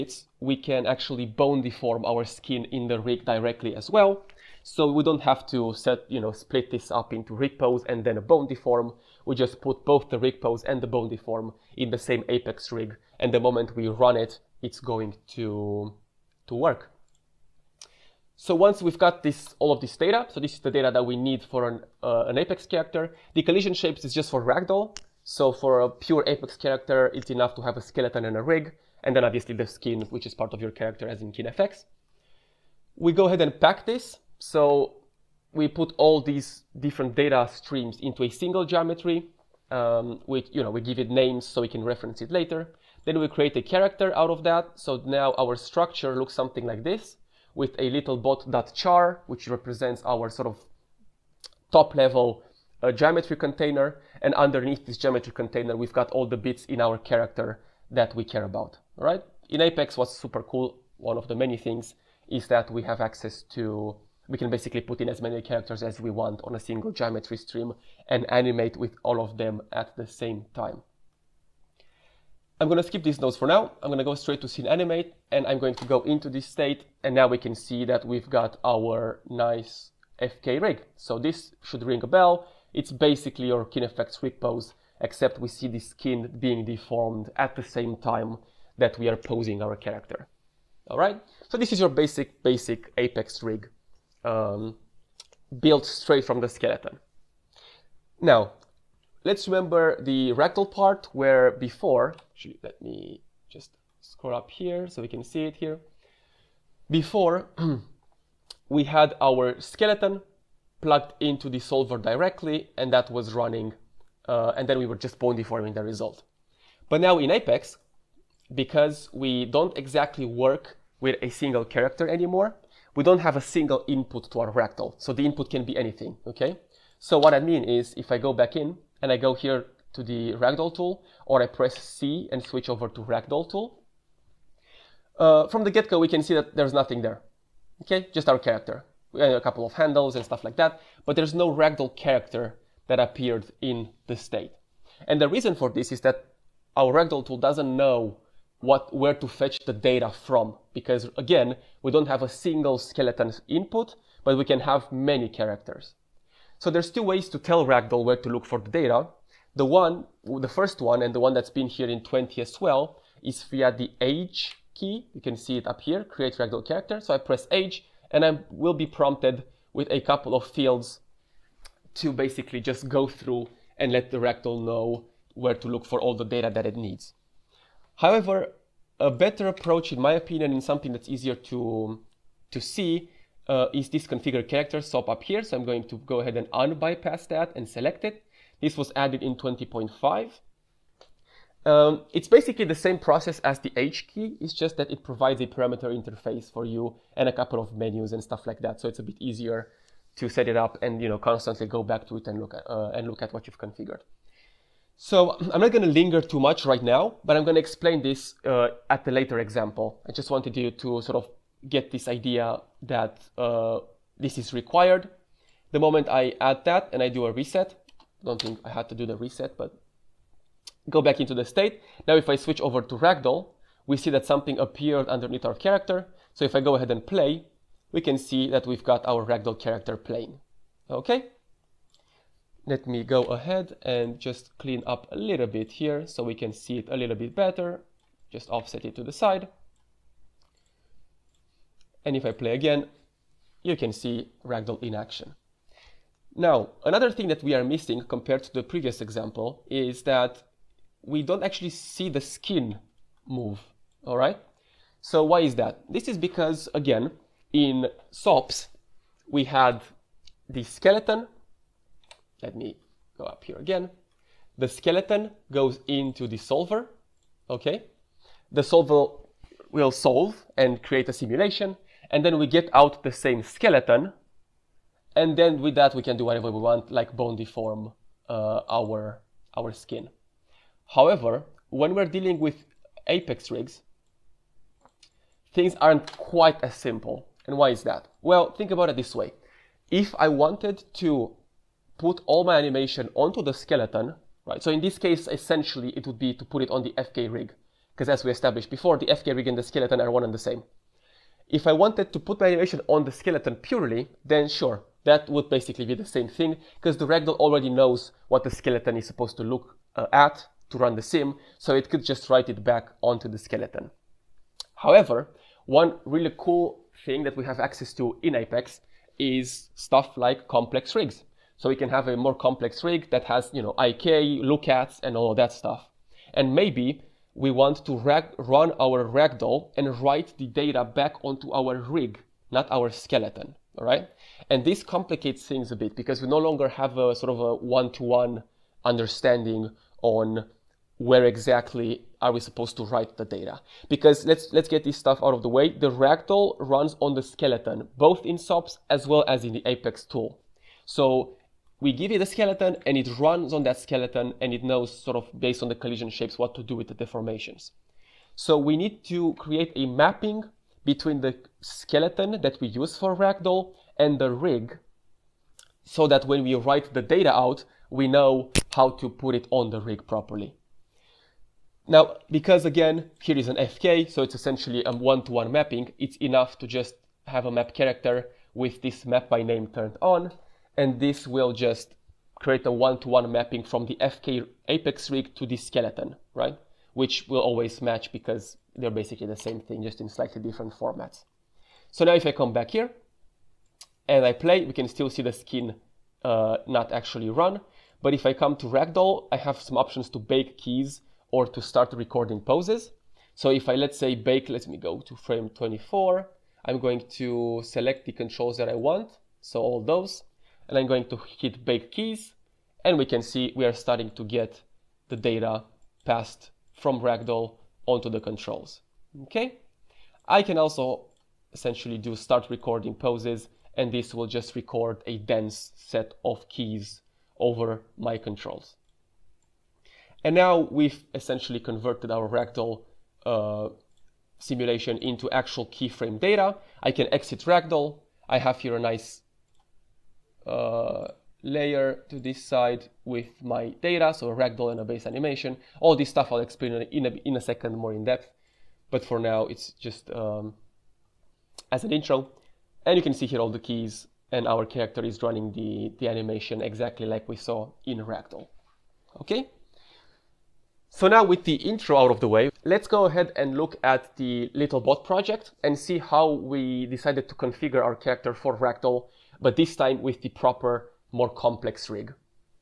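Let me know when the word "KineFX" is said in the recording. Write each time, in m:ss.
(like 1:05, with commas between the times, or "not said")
0:31, 1:23.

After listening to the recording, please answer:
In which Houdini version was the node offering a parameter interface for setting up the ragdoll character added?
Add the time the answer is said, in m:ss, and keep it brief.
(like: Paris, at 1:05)
20.5, at 3:09.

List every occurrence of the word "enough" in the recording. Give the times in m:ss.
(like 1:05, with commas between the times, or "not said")
0:27, 6:16.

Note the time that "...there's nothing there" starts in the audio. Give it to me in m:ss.
2:16.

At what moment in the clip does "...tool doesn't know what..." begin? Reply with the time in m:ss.
2:27.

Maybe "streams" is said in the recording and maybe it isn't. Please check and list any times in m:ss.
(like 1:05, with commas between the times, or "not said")
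0:37, 1:07.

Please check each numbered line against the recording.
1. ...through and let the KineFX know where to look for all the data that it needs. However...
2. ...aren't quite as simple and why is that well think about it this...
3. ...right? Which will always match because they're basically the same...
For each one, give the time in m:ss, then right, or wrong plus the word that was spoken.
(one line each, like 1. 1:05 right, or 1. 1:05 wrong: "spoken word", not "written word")
1. 2:53 wrong: "Ragdoll", not "KineFX"
2. 4:45 right
3. 6:26 right.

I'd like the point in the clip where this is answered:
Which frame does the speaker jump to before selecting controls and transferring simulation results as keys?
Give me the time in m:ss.
6:45.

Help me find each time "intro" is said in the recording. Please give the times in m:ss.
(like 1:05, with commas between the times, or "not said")
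7:31, 7:41.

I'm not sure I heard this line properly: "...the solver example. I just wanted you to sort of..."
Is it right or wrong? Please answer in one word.
wrong.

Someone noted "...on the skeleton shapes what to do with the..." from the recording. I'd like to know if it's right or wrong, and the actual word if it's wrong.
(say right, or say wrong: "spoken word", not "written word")
wrong: "collision", not "skeleton".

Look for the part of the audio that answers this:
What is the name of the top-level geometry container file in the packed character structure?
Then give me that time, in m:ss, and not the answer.
0:48.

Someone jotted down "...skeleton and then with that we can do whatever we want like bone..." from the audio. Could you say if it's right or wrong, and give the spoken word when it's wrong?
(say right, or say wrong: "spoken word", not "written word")
right.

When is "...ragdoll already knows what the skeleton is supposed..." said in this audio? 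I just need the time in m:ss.
5:07.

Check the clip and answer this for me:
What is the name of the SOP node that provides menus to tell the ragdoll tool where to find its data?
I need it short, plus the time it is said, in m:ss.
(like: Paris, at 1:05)
Configure character, at 3:04.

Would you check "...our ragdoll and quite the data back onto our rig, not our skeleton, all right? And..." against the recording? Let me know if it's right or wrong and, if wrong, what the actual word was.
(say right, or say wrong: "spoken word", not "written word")
wrong: "write", not "quite".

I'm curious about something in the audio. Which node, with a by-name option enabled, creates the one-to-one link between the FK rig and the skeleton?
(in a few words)
Map character.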